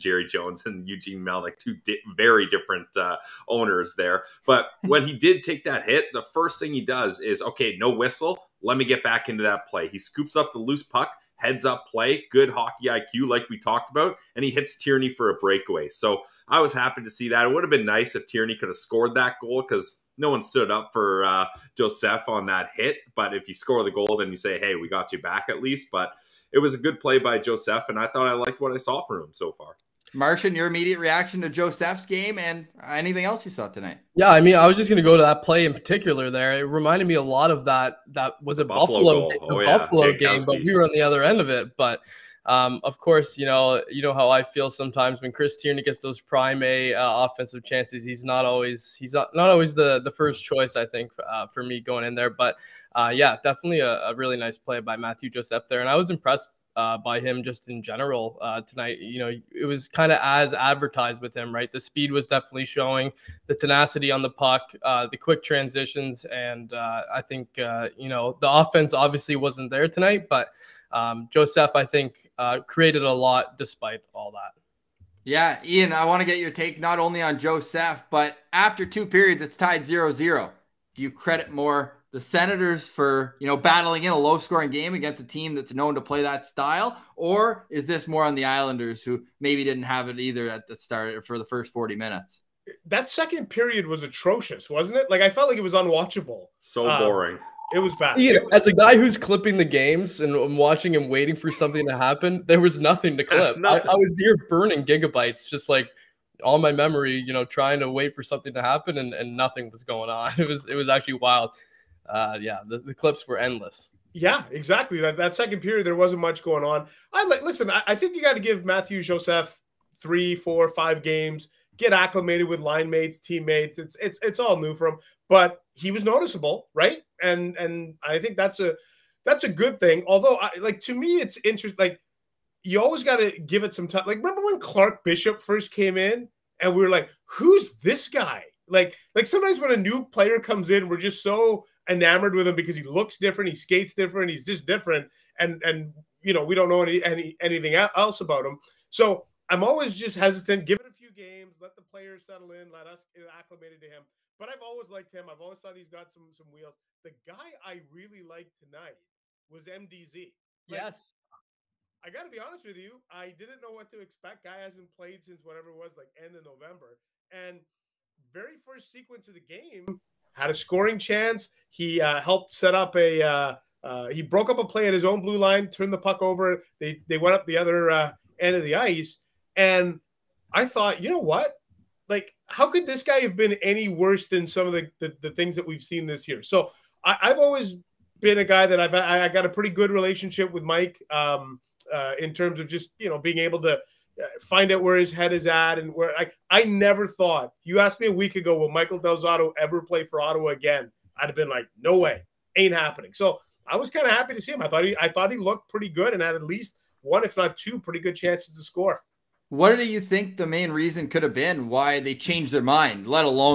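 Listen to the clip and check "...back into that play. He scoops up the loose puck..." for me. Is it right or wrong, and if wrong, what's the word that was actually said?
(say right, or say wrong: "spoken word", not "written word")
right.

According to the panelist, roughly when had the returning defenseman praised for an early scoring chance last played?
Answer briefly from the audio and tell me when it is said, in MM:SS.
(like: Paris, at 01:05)
end of November, at 02:46.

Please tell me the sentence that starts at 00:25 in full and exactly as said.
But it was a good play by Joseph, and I thought I liked what I saw from him so far.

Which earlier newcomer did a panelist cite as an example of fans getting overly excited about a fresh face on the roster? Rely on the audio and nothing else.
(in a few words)
Clark Bishop.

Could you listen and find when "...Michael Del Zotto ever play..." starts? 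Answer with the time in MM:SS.
03:18.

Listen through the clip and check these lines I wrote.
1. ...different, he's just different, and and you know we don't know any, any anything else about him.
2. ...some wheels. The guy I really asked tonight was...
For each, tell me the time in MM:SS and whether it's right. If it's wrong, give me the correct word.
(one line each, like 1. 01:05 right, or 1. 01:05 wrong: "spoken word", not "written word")
1. 02:23 right
2. 02:36 wrong: "liked", not "asked".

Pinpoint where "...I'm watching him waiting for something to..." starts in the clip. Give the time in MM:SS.
01:40.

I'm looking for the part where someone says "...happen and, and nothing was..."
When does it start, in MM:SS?
01:48.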